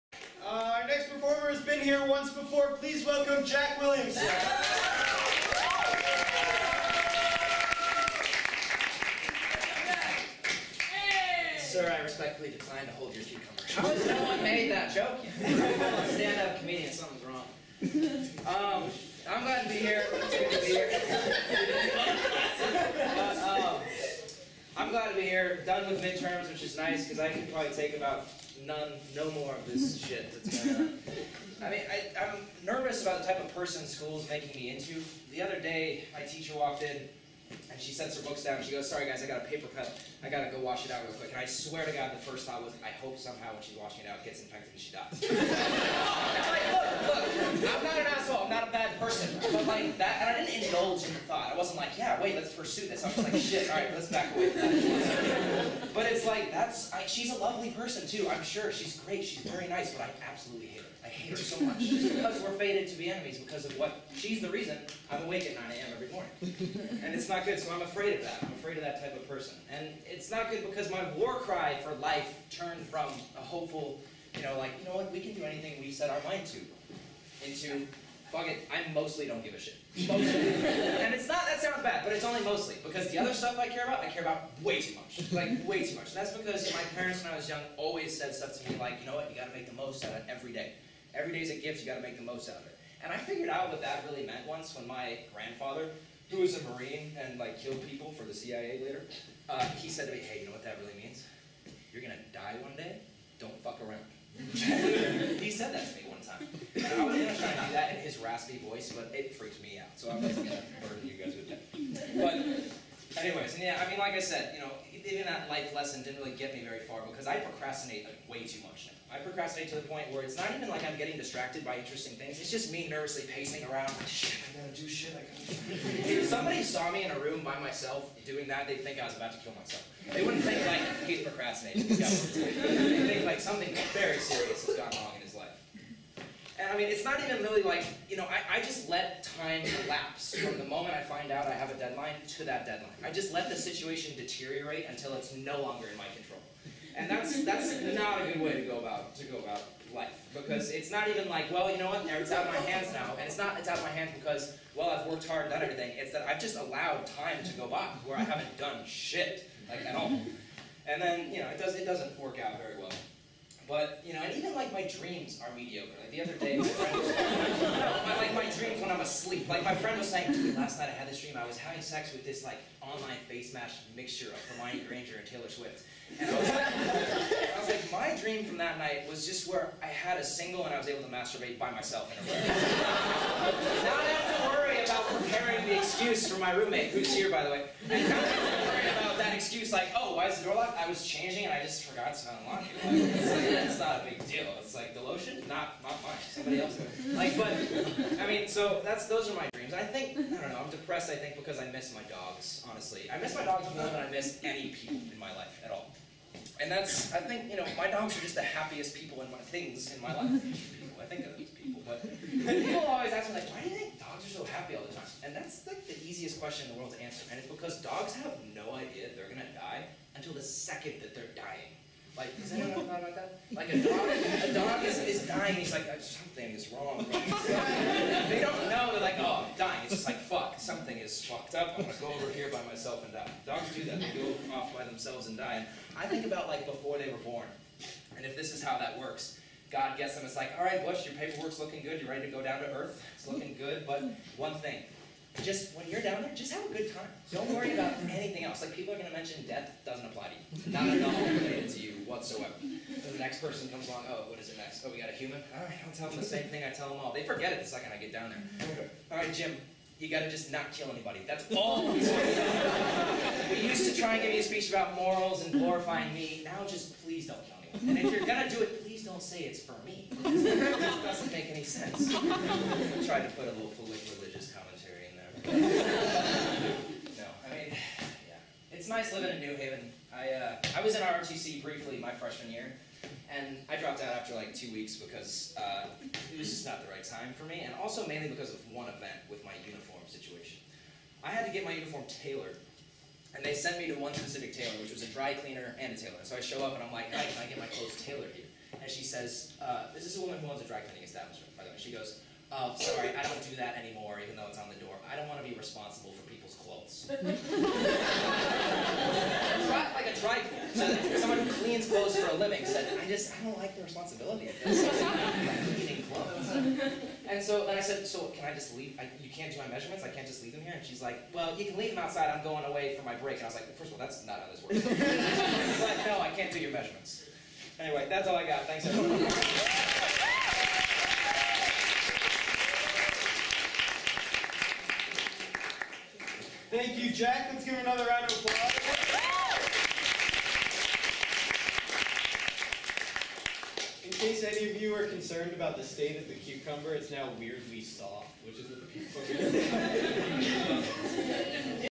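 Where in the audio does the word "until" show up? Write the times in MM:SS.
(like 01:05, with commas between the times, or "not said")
02:24, 03:40.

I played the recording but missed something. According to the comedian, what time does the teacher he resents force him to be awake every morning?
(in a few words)
9 a.m.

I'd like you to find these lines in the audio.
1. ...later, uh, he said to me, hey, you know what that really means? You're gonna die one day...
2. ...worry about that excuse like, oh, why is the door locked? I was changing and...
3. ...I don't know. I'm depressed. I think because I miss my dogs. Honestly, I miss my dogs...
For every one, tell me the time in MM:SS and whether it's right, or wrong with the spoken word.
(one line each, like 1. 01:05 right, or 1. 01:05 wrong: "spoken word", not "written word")
1. 01:38 right
2. 03:08 right
3. 03:20 right.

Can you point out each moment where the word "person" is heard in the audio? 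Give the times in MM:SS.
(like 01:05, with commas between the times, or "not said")
00:33, 00:48, 00:57, 01:09, 04:13.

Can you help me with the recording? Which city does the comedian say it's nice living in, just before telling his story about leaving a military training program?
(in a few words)
New Haven.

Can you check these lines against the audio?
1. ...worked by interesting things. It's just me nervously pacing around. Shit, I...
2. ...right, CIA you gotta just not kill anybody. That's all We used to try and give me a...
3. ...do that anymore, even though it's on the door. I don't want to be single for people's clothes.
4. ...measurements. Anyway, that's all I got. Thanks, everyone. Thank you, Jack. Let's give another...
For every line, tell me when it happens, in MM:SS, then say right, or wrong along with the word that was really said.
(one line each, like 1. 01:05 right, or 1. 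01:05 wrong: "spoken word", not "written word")
1. 02:01 wrong: "distracted", not "worked"
2. 04:19 wrong: "Jim", not "CIA"
3. 05:03 wrong: "responsible", not "single"
4. 05:26 right.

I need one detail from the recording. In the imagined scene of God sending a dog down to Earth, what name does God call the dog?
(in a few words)
Bush.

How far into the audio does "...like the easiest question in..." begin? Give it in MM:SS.
03:35.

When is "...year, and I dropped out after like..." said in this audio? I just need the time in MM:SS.
04:42.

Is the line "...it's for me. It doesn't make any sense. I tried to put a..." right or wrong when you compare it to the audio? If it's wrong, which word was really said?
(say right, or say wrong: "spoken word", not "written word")
right.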